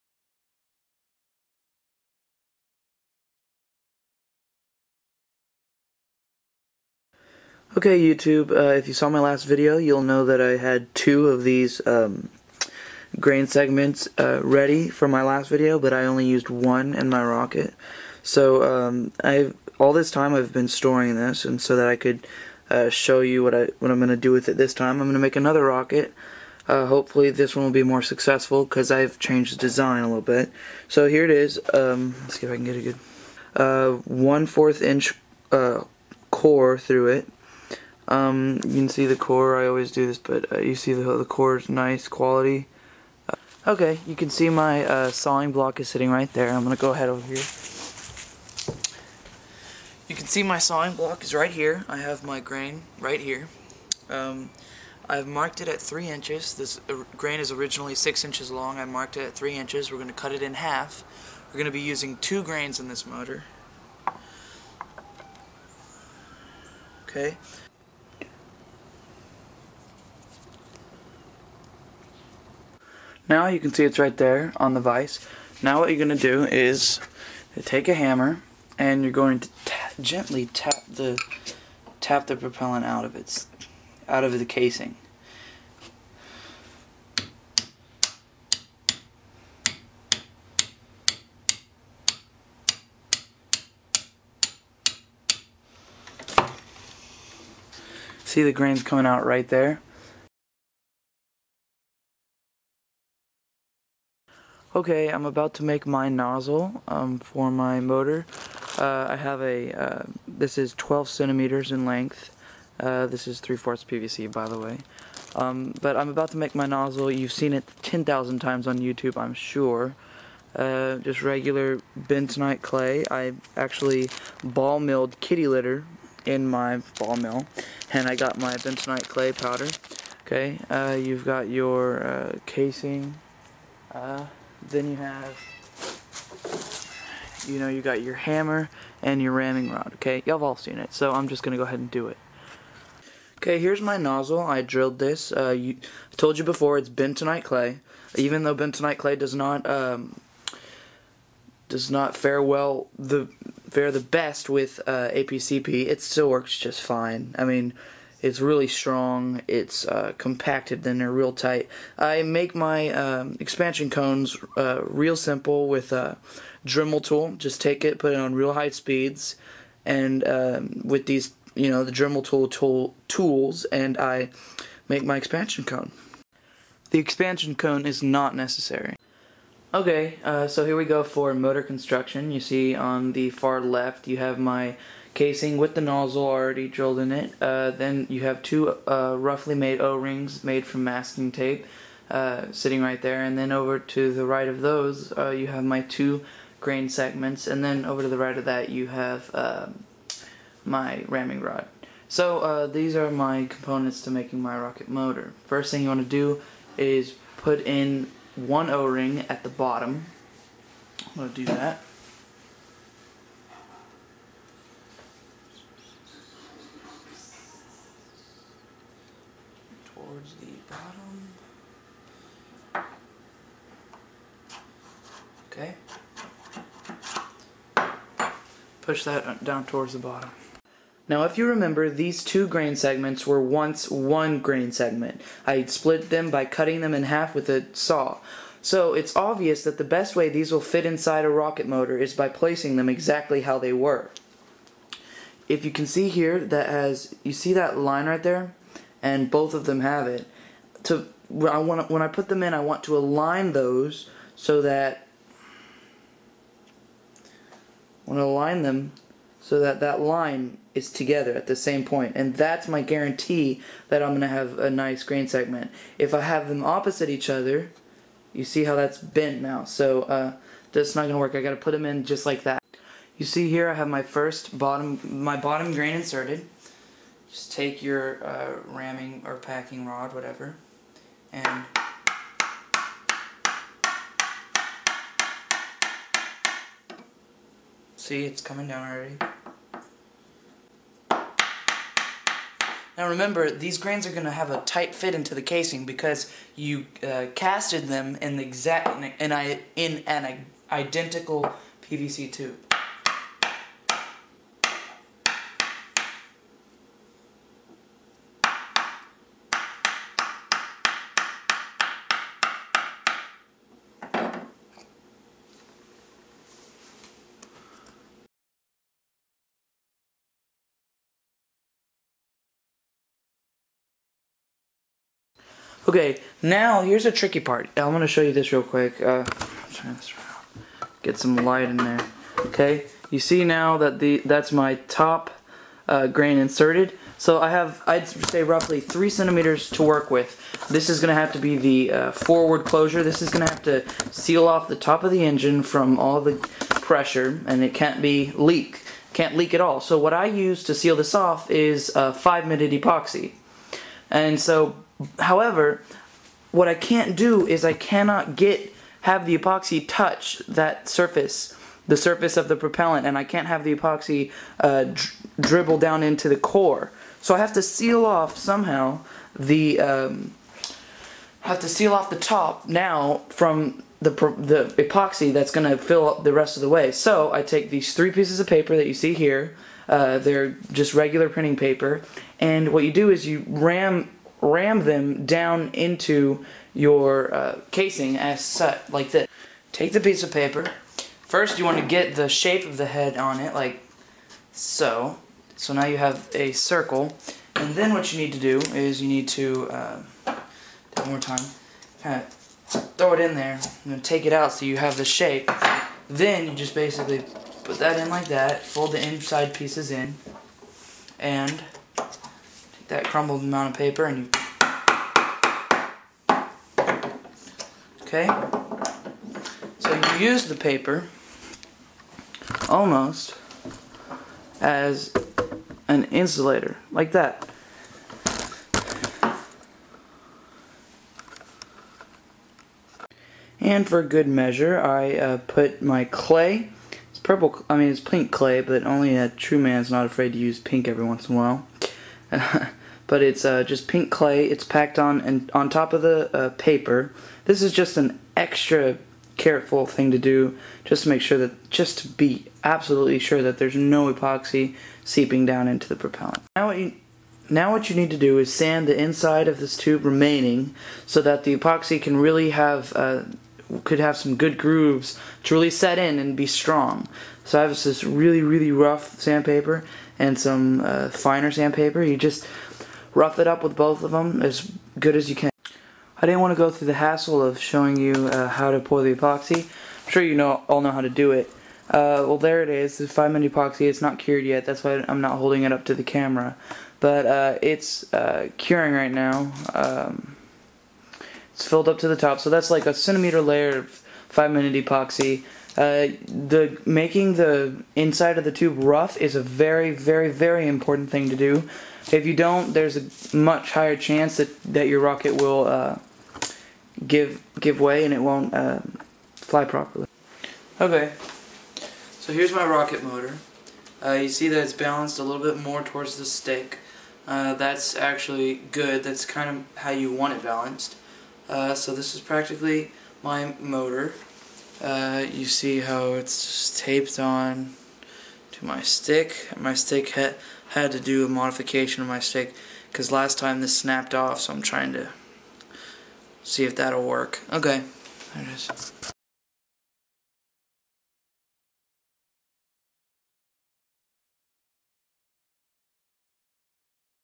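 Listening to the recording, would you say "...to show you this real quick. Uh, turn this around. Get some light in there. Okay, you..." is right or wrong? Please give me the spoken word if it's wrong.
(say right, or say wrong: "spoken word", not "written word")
right.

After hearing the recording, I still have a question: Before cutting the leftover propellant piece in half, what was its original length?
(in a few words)
6 inches.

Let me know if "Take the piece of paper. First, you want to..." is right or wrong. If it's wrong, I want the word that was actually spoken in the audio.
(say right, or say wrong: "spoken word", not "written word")
right.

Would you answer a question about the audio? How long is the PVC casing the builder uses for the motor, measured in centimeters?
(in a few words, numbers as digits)
12 centimeters.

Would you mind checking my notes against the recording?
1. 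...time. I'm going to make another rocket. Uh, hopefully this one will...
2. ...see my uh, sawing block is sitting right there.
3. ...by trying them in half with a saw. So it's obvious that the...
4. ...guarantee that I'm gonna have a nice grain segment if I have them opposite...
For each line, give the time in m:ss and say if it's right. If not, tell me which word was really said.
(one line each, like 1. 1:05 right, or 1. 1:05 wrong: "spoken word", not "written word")
1. 0:24 right
2. 0:44 right
3. 3:56 wrong: "cutting", not "trying"
4. 4:22 right.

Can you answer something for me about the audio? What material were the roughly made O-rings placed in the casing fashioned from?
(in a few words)
Masking tape.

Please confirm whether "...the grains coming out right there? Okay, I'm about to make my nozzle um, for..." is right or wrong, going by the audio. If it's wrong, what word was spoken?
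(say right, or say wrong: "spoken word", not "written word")
right.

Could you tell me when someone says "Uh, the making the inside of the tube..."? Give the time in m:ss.
8:15.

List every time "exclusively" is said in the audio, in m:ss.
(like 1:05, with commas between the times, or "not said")
not said.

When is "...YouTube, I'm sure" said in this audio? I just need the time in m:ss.
1:58.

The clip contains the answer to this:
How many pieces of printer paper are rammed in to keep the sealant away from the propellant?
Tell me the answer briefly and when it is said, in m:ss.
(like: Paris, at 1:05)
3, at 6:17.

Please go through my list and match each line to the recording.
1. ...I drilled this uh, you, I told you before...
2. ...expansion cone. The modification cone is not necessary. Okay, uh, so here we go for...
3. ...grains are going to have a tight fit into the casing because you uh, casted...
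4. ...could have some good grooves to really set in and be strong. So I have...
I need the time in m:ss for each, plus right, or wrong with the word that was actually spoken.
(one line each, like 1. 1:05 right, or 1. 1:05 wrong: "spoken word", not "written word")
1. 2:24 right
2. 2:55 wrong: "expansion", not "modification"
3. 4:53 right
4. 7:43 right.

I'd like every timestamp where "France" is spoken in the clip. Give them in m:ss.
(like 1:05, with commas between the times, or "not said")
not said.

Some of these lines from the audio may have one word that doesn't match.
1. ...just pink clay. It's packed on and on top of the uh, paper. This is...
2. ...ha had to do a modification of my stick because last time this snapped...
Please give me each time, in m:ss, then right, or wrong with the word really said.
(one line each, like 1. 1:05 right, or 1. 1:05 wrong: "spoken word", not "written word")
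1. 7:23 right
2. 8:50 right.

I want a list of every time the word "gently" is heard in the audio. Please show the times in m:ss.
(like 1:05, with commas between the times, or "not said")
1:20.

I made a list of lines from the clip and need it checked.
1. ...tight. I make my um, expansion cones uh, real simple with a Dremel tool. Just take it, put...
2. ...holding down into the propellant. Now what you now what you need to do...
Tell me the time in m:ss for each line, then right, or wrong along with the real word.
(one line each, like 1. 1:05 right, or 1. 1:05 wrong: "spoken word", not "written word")
1. 2:41 right
2. 7:35 wrong: "seeping", not "holding".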